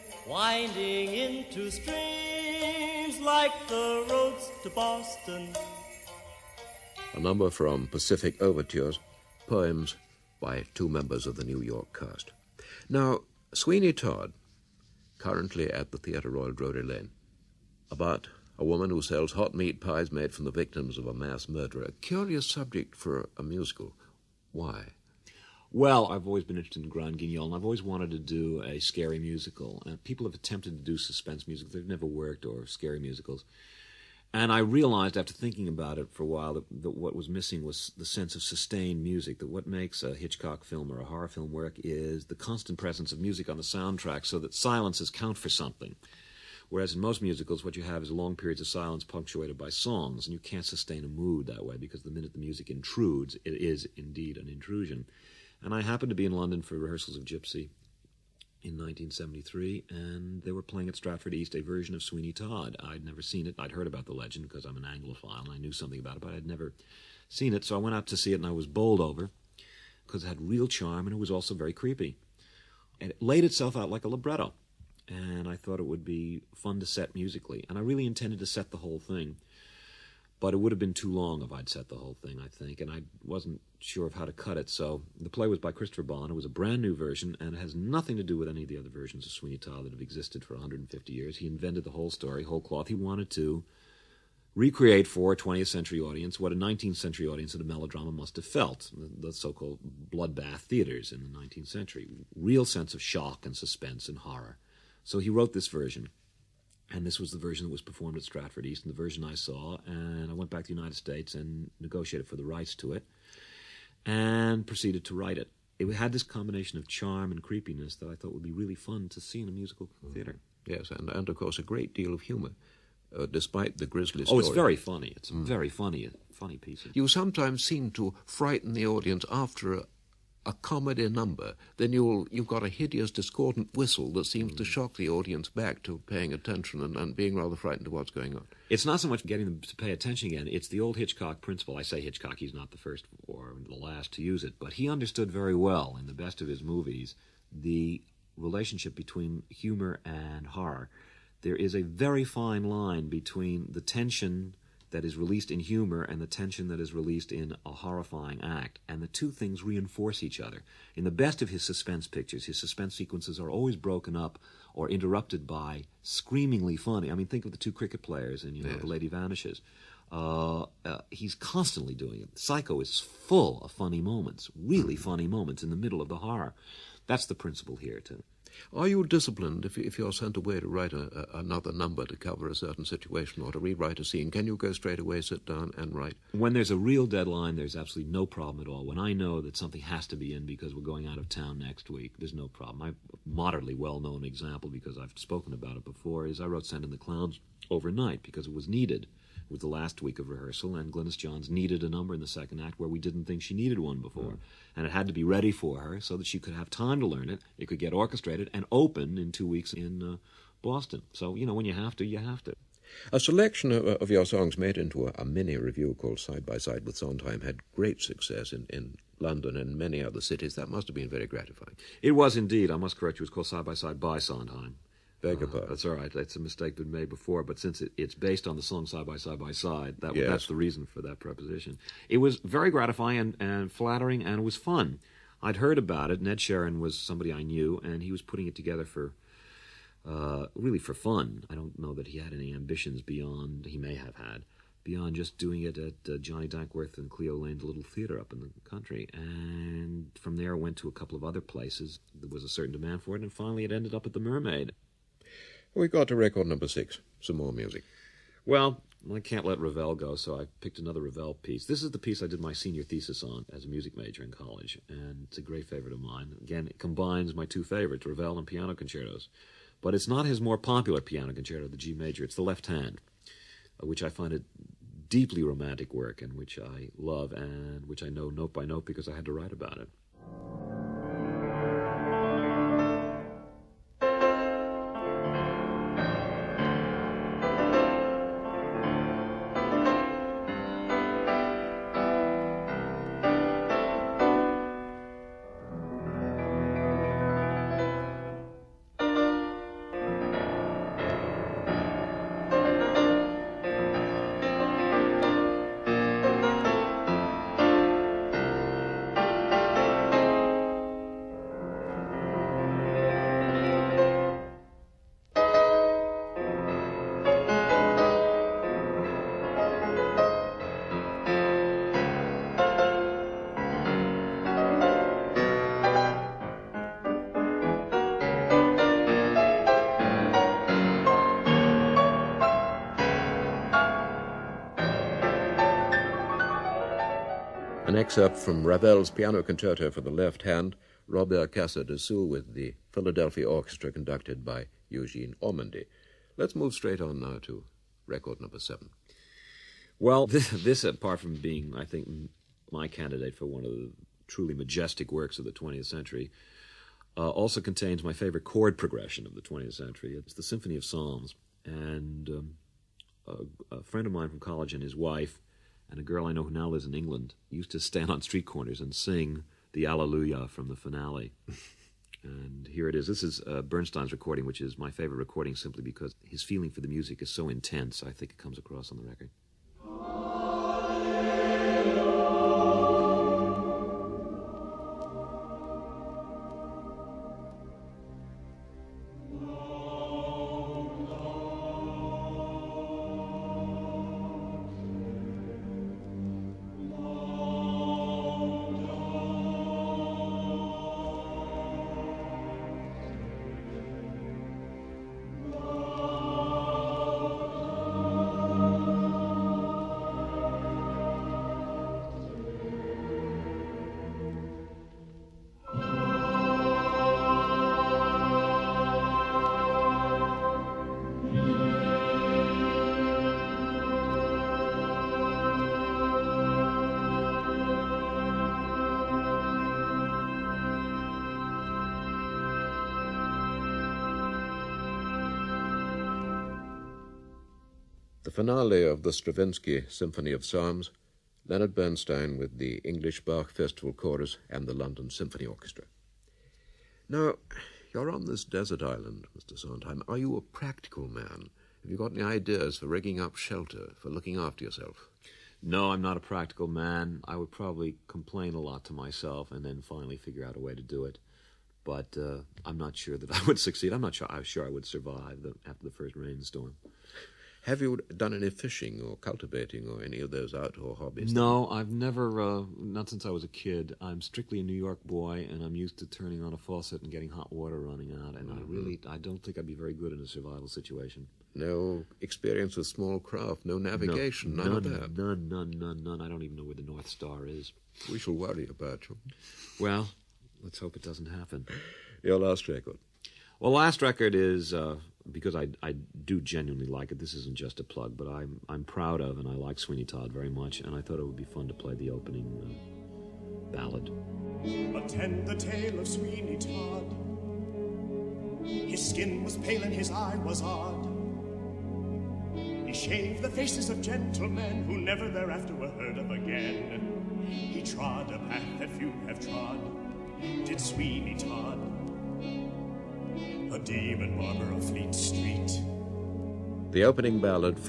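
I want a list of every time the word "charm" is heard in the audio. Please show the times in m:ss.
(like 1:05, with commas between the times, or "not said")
1:10, 1:56.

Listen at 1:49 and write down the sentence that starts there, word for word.
And I went back to the United States and negotiated for the rights to it and proceeded to write it.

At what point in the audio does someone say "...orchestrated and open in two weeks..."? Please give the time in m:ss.
3:27.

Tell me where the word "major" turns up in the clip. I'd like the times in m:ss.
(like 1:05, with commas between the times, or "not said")
4:23, 4:31.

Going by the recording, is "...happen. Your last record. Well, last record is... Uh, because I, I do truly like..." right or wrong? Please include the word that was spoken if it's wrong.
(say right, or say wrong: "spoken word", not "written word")
wrong: "genuinely", not "truly".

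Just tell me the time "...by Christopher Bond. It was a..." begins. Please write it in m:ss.
1:25.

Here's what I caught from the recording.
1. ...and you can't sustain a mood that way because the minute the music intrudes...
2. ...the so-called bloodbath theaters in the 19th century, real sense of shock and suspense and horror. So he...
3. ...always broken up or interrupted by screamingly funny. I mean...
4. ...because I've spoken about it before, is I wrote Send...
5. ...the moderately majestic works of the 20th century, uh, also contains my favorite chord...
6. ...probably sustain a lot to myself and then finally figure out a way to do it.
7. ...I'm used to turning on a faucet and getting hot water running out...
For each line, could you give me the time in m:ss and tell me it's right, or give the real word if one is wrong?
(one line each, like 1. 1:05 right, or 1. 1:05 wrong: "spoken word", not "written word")
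1. 0:50 right
2. 1:39 right
3. 2:43 right
4. 3:14 right
5. 5:53 wrong: "truly", not "moderately"
6. 7:37 wrong: "complain", not "sustain"
7. 7:55 right.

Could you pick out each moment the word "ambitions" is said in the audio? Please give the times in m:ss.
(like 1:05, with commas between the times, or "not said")
4:02.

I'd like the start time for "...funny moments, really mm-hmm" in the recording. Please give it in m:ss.
2:53.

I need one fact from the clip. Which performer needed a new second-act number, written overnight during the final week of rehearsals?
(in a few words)
Glynis Johns.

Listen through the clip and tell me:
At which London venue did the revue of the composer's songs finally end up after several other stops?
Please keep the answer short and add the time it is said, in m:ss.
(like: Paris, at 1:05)
The Mermaid, at 4:14.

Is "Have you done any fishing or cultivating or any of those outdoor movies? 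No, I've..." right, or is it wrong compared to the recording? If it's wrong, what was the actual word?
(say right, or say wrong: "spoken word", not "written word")
wrong: "hobbies", not "movies".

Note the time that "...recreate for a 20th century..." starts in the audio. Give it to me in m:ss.
1:34.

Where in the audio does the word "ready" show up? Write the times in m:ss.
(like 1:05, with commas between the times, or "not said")
3:25.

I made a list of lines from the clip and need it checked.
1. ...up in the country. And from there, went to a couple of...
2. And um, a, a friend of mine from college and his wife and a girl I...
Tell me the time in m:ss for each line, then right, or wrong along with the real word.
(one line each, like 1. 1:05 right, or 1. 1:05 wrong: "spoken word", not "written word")
1. 4:08 right
2. 6:01 right.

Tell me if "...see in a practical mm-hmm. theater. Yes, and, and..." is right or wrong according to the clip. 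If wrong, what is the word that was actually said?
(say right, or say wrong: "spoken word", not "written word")
wrong: "musical", not "practical".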